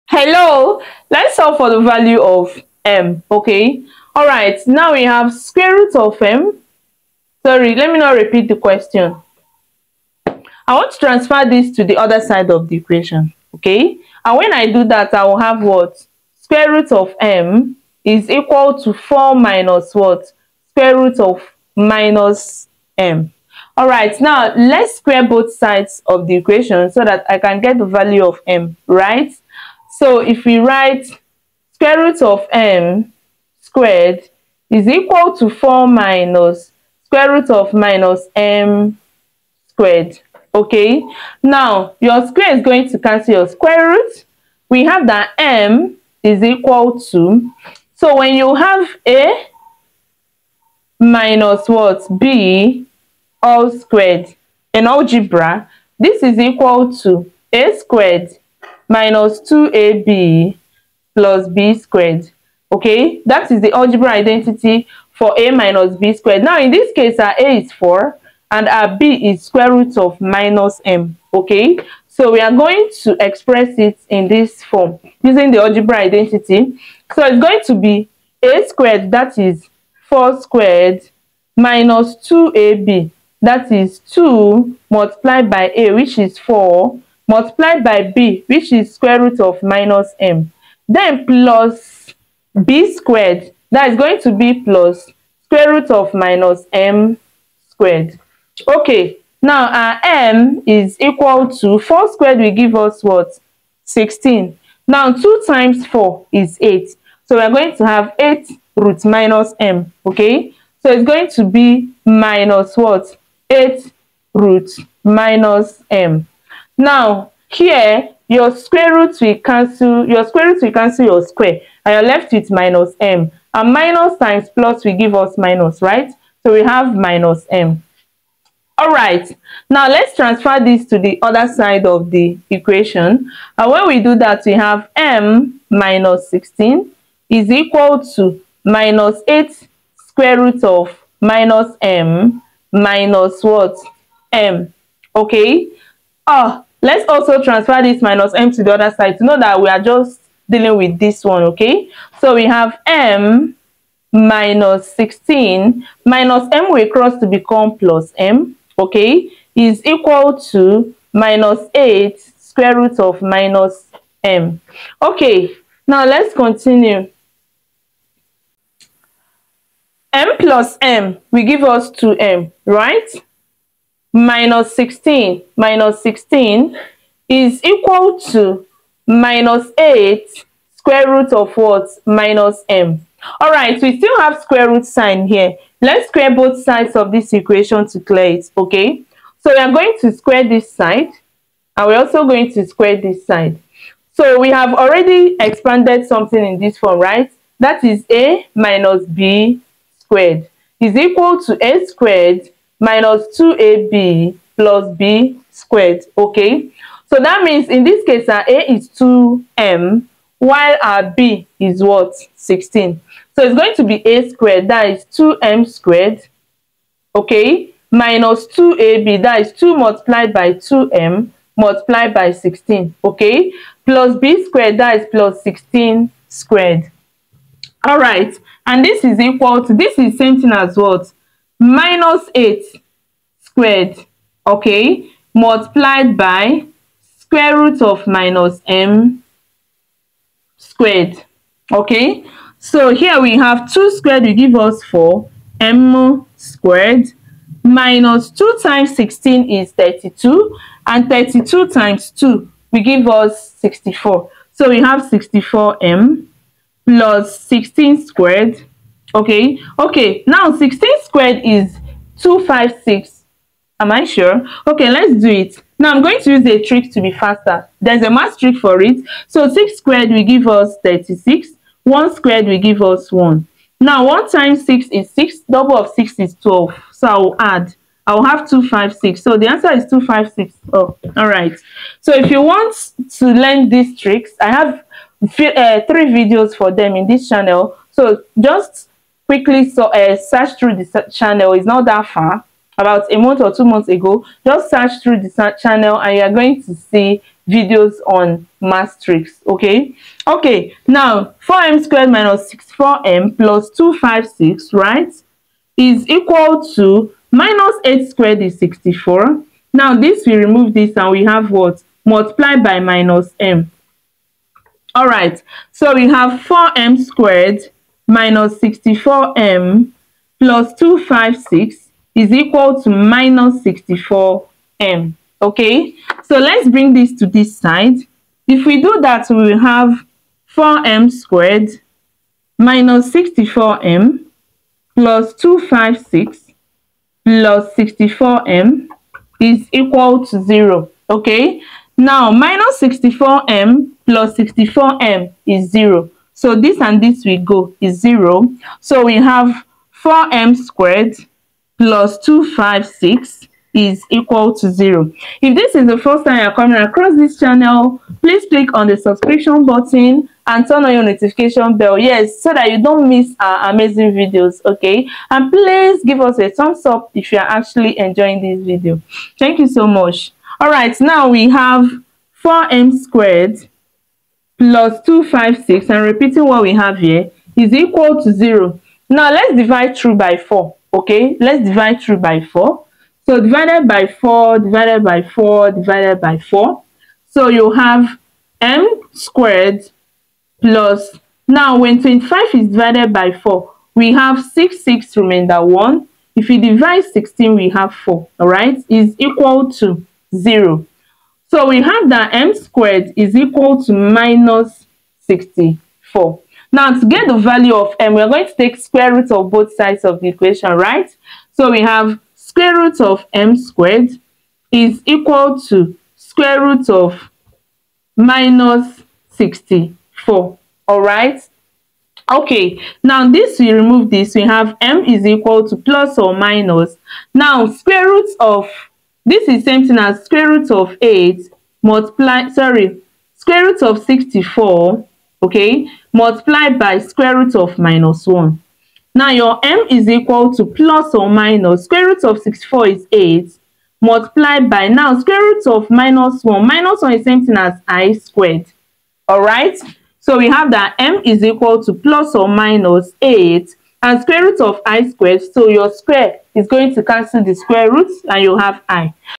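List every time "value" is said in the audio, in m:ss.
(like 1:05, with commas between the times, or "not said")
0:01, 0:27, 6:47.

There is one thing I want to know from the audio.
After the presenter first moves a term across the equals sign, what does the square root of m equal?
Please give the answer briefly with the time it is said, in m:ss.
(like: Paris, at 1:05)
4 minus square root of minus m, at 0:18.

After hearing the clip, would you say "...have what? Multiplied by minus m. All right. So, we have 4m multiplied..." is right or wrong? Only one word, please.
wrong.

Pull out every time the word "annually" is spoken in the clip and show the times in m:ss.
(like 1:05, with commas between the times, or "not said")
not said.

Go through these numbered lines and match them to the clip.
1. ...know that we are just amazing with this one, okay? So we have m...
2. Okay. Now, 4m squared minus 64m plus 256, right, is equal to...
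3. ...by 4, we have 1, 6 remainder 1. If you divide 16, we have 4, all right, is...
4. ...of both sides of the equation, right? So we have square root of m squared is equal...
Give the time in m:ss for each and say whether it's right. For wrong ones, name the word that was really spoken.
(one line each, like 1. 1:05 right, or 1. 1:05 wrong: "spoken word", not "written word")
1. 2:29 wrong: "dealing", not "amazing"
2. 5:00 right
3. 6:33 wrong: "6", not "1"
4. 6:49 right.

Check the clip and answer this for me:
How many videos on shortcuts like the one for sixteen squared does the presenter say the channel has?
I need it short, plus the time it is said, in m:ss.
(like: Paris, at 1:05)
3, at 4:45.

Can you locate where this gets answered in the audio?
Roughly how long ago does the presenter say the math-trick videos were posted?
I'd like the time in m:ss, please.
4:52.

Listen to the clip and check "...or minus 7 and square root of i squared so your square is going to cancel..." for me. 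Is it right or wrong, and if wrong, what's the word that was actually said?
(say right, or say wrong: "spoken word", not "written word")
wrong: "8", not "7".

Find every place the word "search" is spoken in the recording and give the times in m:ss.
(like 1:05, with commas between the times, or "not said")
4:50, 4:54.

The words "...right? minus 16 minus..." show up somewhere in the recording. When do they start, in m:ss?
2:52.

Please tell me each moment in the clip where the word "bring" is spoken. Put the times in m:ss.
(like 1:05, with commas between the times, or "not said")
5:26.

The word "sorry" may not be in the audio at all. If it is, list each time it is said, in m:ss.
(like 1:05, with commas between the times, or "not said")
0:07, 7:12.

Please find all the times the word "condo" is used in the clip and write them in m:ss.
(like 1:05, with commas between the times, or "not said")
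not said.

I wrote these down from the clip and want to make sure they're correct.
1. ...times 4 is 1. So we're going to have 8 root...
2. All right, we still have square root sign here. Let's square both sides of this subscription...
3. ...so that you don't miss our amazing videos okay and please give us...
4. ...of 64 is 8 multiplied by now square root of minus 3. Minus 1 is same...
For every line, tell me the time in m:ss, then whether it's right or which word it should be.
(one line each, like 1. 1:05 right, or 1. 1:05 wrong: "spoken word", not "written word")
1. 1:45 wrong: "8", not "1"
2. 3:03 wrong: "equation", not "subscription"
3. 6:02 right
4. 7:22 wrong: "1", not "3".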